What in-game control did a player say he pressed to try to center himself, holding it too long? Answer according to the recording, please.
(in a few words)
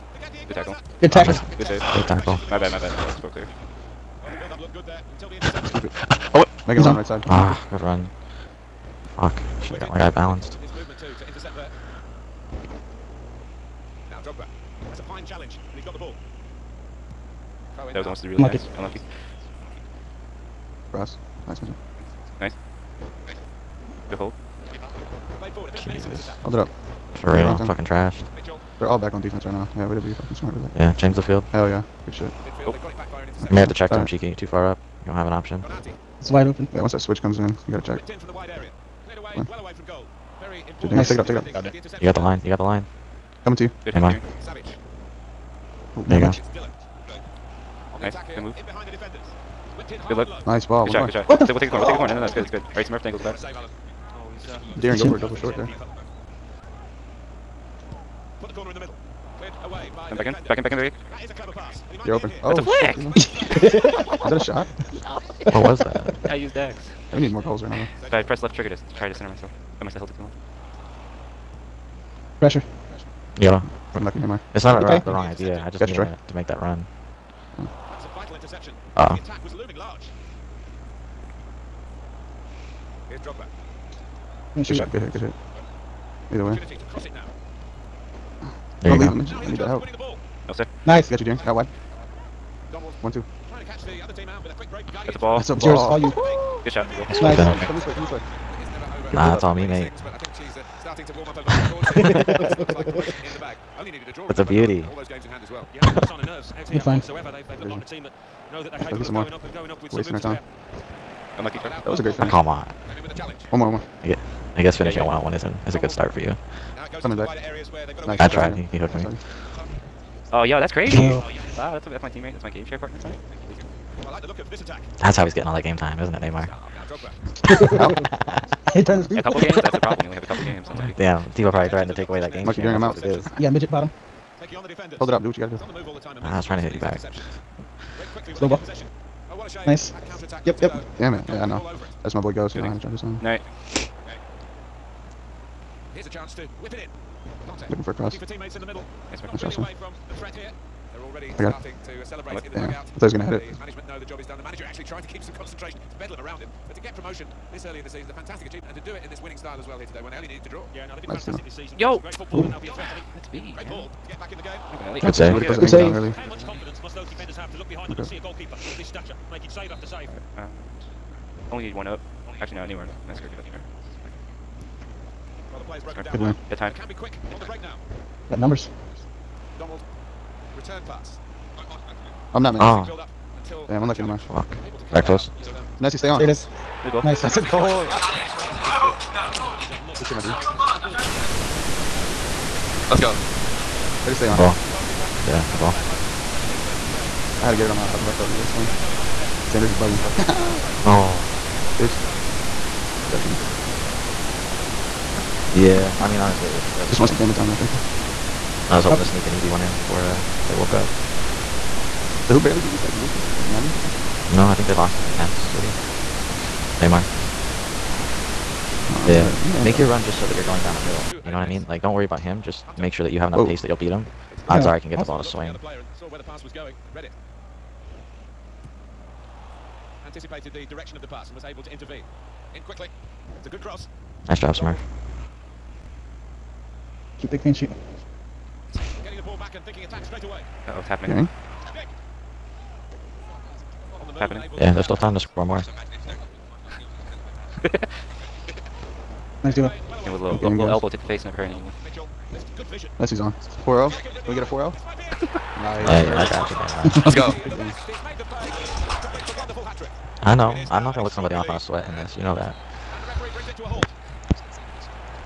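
left trigger.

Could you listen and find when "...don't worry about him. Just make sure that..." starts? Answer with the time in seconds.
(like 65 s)
221 s.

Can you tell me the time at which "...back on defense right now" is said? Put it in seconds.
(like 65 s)
28 s.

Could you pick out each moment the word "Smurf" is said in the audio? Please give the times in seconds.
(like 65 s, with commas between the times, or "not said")
52 s, 234 s.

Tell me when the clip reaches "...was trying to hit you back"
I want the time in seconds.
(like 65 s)
136 s.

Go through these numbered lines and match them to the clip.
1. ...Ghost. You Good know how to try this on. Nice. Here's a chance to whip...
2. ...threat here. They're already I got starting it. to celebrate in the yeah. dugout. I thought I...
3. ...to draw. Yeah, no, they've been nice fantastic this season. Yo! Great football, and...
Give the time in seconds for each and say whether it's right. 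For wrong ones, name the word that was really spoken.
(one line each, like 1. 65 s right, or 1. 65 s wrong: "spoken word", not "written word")
1. 142 s right
2. 150 s right
3. 160 s right.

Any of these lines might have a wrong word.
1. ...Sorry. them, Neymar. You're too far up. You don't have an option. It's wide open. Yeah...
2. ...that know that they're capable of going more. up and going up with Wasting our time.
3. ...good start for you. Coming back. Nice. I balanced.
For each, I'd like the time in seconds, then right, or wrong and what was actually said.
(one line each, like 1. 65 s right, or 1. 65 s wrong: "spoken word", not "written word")
1. 33 s wrong: "Cheeky", not "Neymar"
2. 108 s right
3. 115 s wrong: "tried", not "balanced".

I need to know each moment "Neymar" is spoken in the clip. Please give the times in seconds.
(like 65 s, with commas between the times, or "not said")
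74 s, 126 s, 172 s, 216 s.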